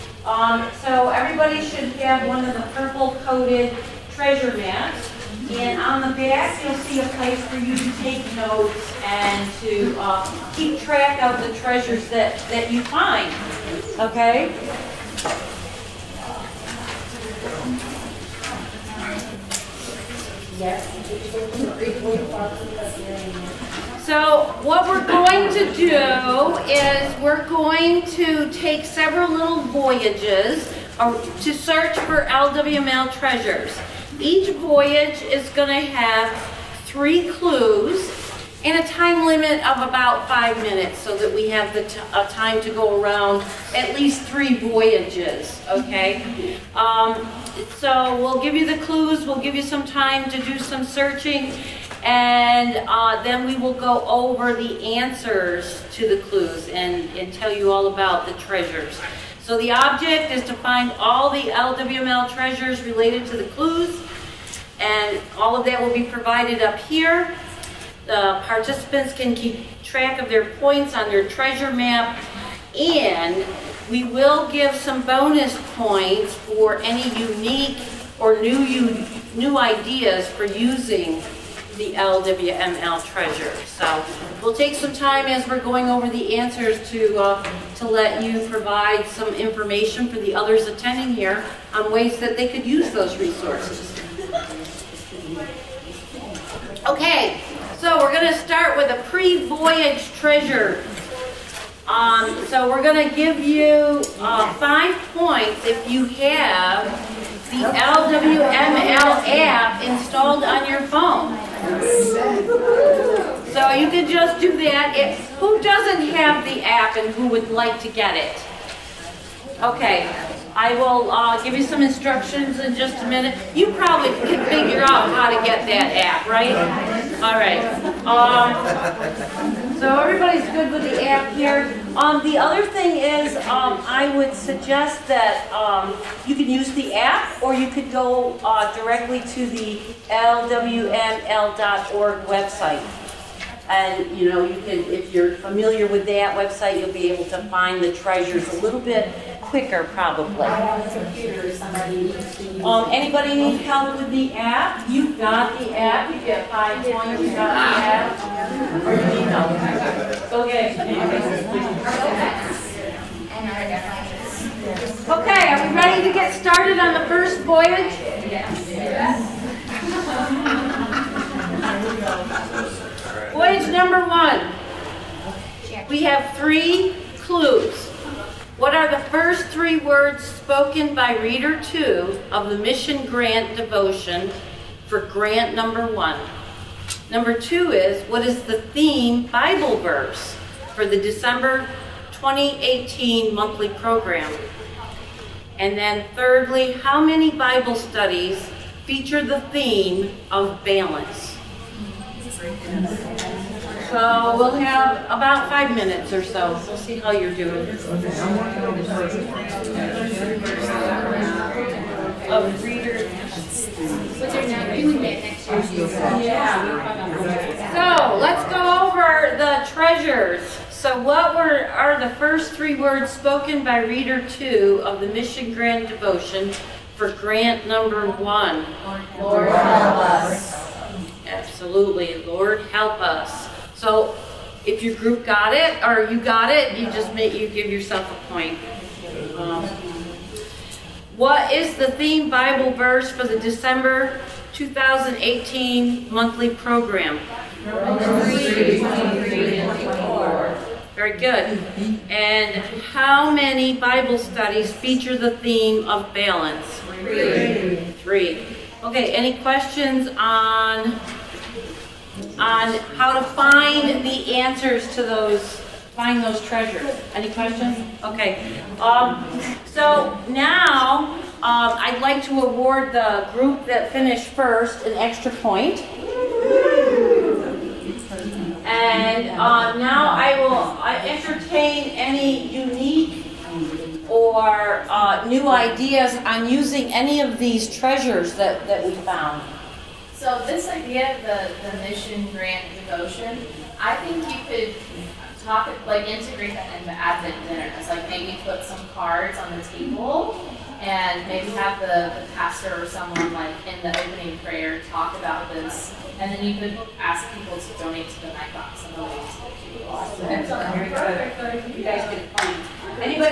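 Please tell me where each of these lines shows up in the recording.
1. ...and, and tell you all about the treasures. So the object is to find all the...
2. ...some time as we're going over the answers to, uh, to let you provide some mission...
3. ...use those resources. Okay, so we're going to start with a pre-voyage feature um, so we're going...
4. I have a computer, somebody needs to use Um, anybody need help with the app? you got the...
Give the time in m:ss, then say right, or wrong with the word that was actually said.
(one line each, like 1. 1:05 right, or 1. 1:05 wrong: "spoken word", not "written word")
1. 0:56 right
2. 1:24 wrong: "information", not "mission"
3. 1:32 wrong: "treasure", not "feature"
4. 2:30 right.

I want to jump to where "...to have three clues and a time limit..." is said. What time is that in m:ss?
0:35.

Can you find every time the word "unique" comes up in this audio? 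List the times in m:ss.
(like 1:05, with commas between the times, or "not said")
1:17, 4:42.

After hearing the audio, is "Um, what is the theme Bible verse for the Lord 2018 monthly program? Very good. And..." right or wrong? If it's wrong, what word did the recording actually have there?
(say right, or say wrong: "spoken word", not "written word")
wrong: "December", not "Lord".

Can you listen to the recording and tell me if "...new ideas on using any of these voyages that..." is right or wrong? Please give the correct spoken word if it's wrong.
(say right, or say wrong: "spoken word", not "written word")
wrong: "treasures", not "voyages".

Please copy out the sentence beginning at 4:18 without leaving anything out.
Okay, any questions on on how to find the answers to those, find those treasures.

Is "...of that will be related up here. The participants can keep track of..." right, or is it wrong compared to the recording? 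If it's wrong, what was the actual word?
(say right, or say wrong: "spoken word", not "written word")
wrong: "provided", not "related".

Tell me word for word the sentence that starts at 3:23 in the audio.
So we'll have about five minutes or so.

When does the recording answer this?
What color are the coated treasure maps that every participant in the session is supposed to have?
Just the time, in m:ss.
0:02.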